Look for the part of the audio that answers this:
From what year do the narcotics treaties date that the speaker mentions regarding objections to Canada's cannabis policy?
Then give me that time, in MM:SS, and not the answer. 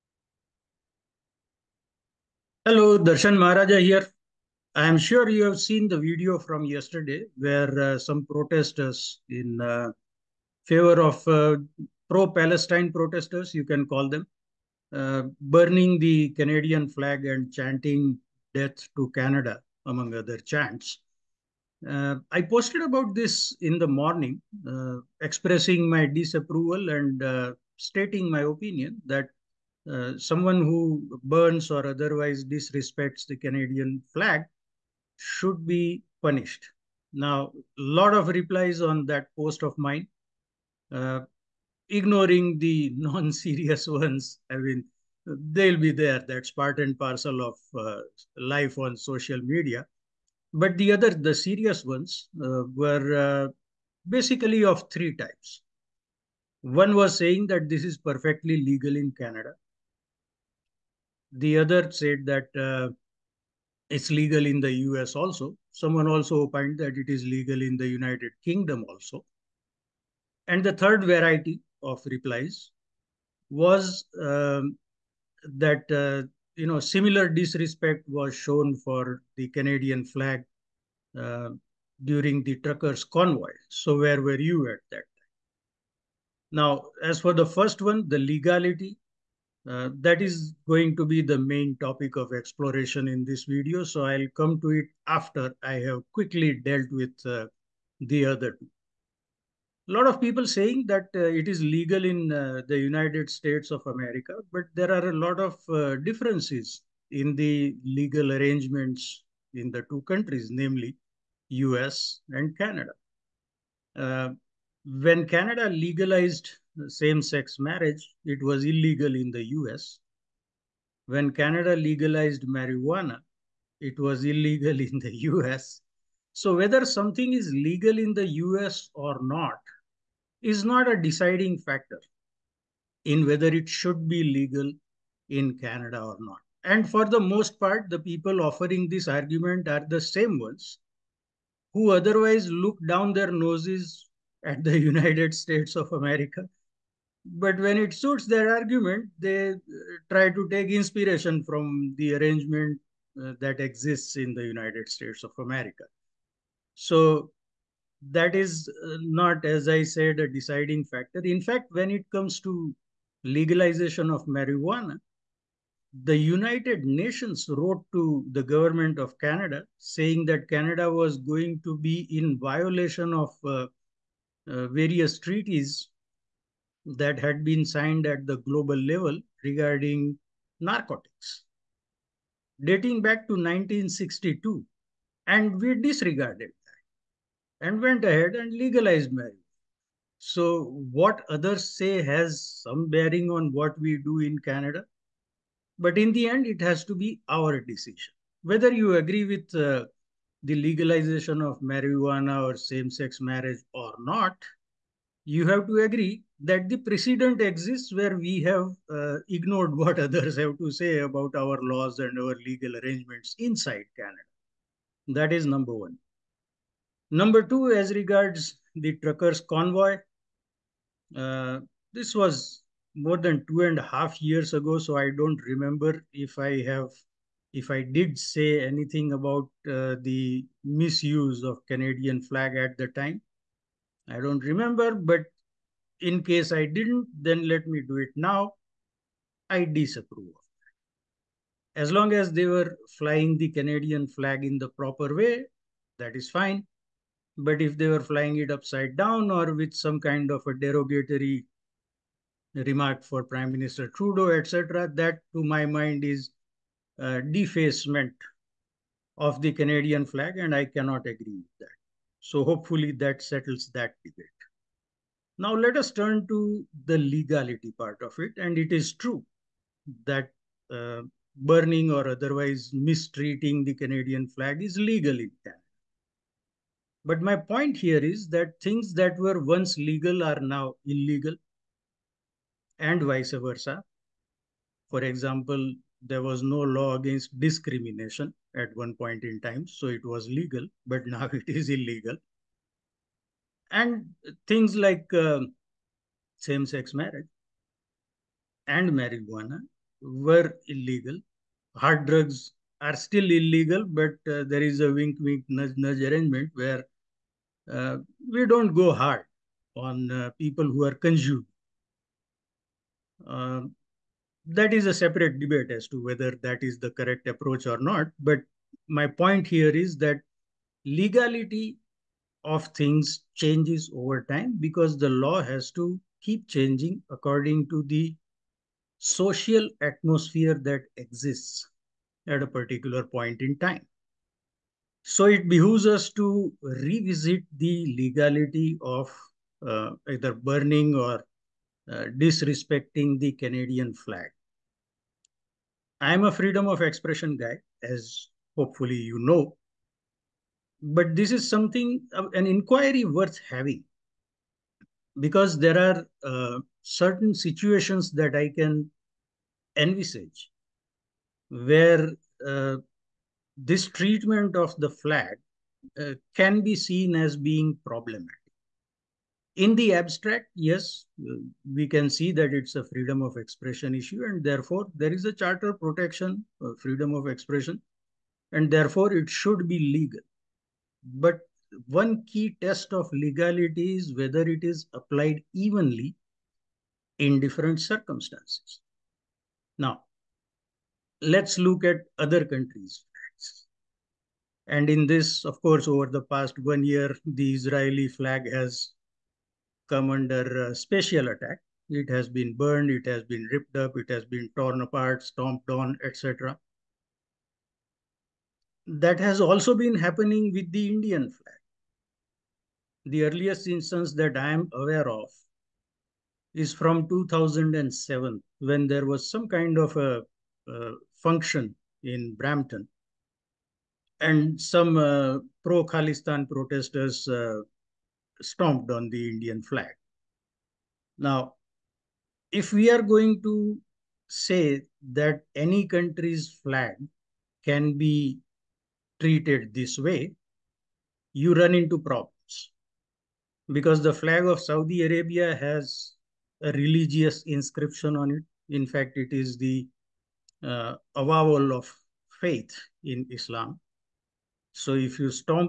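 03:03.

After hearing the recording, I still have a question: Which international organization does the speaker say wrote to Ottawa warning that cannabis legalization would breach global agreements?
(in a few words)
United Nations.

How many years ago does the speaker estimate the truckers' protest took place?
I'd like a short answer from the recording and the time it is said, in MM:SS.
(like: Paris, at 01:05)
two and a half years, at 03:43.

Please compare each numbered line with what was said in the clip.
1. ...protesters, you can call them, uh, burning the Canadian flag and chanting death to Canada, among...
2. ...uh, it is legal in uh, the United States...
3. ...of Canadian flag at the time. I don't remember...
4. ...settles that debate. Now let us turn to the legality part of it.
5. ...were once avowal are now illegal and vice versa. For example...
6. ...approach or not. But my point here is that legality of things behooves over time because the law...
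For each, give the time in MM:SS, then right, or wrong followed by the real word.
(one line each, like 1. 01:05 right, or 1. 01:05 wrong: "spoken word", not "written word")
1. 00:12 right
2. 01:41 right
3. 03:51 right
4. 04:23 right
5. 04:39 wrong: "legal", not "avowal"
6. 05:17 wrong: "changes", not "behooves".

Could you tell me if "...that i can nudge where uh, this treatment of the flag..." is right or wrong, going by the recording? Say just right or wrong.
wrong.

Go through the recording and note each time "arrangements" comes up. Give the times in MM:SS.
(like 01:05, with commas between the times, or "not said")
01:48, 02:32, 03:32, 05:06.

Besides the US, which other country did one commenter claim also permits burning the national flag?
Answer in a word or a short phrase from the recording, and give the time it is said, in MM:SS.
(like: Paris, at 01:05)
United Kingdom, at 01:07.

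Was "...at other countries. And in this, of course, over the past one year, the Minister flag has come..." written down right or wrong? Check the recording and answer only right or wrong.
wrong.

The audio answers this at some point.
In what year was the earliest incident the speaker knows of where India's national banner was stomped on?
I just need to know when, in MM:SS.
06:57.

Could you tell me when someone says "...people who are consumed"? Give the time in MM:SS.
05:10.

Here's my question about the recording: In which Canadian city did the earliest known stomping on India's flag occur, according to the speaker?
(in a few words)
Brampton.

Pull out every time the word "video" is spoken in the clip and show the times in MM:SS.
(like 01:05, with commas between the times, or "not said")
00:05, 01:33.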